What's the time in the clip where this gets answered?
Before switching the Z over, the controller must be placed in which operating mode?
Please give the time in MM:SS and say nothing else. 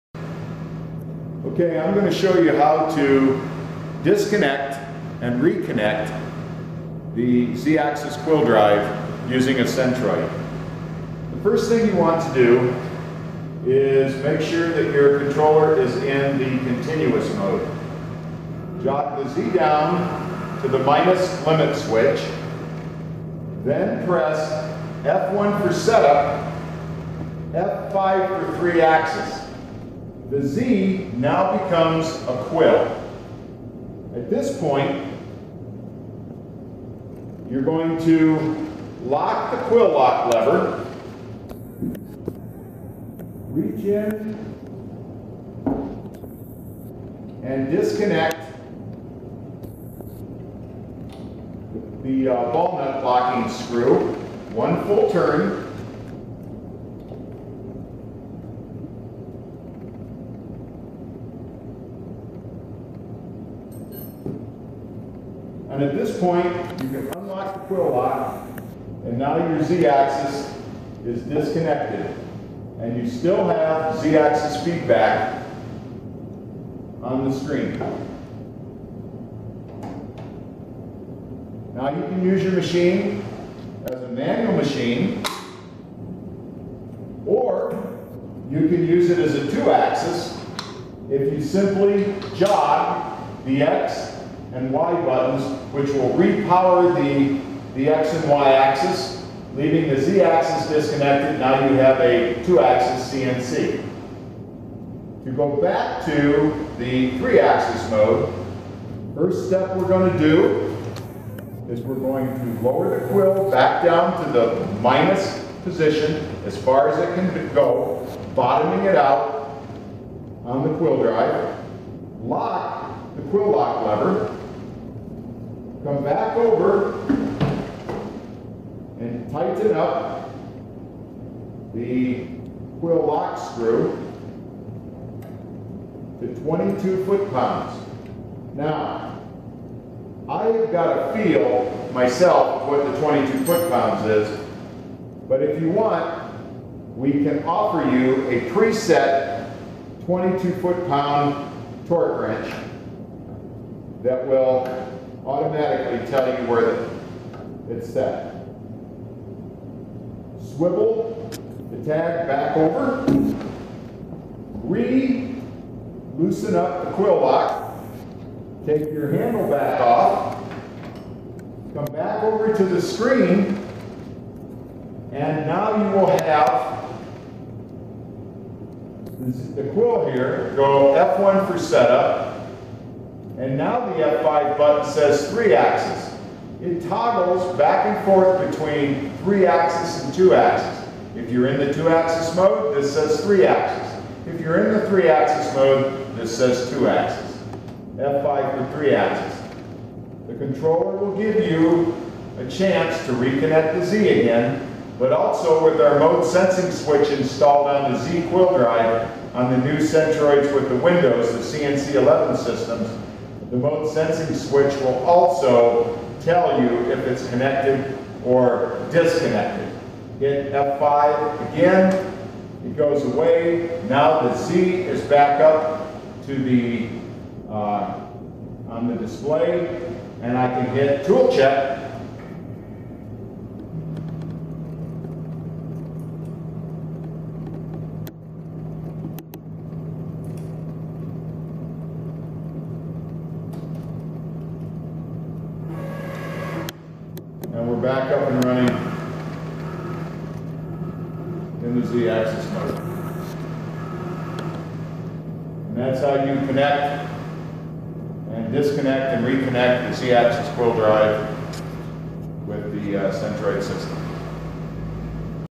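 00:16.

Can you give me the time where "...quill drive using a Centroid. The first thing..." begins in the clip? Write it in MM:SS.
00:08.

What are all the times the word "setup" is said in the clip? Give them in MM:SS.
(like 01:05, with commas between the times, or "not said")
00:25, 03:01.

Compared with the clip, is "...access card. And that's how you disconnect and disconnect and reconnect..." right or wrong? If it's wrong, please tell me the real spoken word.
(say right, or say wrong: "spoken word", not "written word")
wrong: "connect", not "disconnect".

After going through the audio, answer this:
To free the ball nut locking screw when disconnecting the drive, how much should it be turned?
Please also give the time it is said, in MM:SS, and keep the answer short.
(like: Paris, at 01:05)
One full turn, at 00:54.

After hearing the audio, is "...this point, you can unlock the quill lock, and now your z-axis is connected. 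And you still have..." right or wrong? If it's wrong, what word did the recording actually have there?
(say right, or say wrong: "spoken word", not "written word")
wrong: "disconnected", not "connected".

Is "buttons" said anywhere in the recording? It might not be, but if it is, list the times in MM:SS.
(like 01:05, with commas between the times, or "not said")
01:35, 03:04.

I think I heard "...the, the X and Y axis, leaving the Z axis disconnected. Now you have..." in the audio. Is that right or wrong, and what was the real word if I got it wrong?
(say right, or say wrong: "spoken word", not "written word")
right.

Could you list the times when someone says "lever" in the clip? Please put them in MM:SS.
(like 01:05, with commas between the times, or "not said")
00:40, 02:03.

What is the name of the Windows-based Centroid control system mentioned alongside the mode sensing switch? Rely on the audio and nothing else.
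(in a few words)
CNC11.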